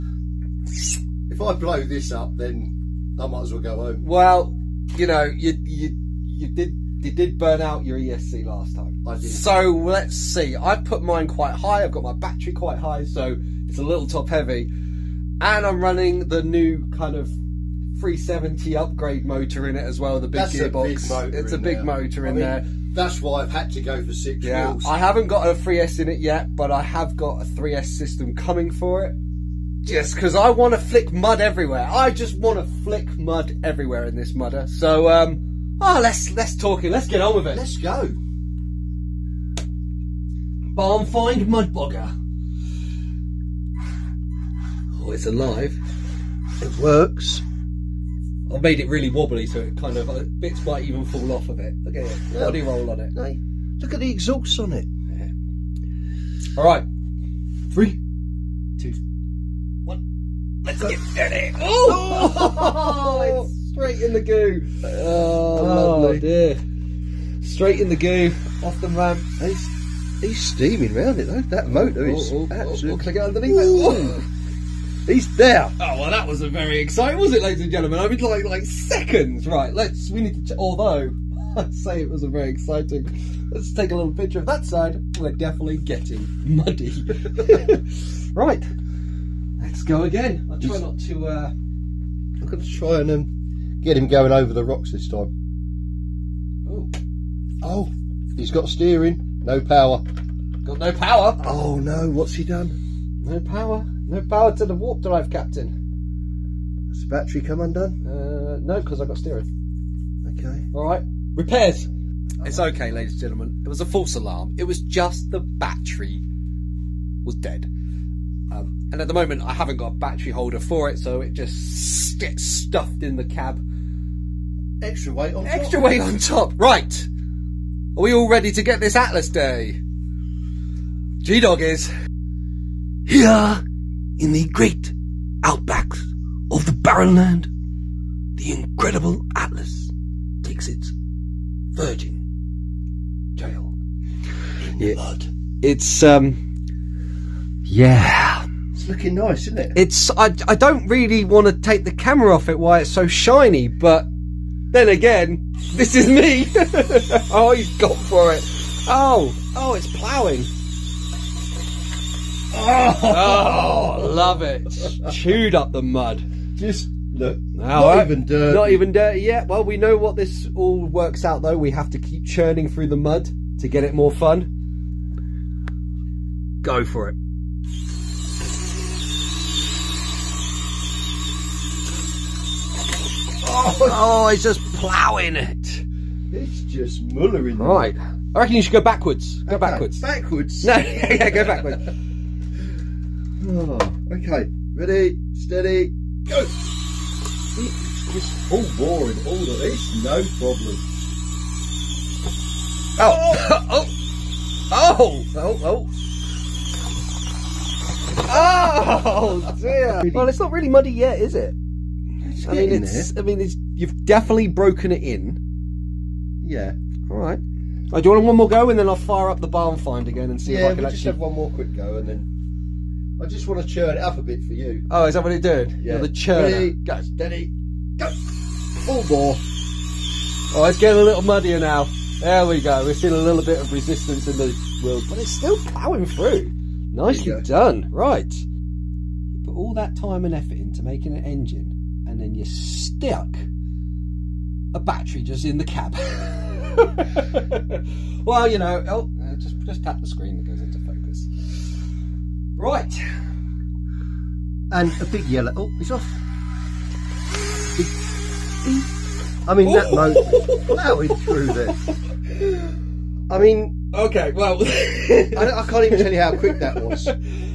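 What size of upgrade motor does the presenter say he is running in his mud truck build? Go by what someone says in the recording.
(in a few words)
370.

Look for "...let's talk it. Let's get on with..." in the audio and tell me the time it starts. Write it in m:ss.
0:36.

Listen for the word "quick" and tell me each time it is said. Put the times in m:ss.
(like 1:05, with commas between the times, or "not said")
3:41, 4:26.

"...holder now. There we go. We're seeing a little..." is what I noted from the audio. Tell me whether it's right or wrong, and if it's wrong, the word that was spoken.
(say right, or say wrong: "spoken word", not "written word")
wrong: "muddier", not "holder".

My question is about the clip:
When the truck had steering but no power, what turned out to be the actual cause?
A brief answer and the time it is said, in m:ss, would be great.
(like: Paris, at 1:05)
The battery was dead, at 1:55.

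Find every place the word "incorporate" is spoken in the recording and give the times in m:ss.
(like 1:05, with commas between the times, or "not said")
not said.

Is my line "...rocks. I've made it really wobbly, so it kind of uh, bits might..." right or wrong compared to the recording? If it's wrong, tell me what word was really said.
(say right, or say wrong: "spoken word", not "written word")
wrong: "works", not "rocks".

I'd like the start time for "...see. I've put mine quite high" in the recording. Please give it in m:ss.
0:10.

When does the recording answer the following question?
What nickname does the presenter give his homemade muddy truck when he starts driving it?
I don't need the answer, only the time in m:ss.
0:40.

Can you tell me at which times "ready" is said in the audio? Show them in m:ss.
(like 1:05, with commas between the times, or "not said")
2:08, 3:14, 3:46.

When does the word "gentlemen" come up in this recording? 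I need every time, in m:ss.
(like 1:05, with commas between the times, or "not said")
1:17, 1:53.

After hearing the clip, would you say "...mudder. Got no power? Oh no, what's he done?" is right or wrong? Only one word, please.
wrong.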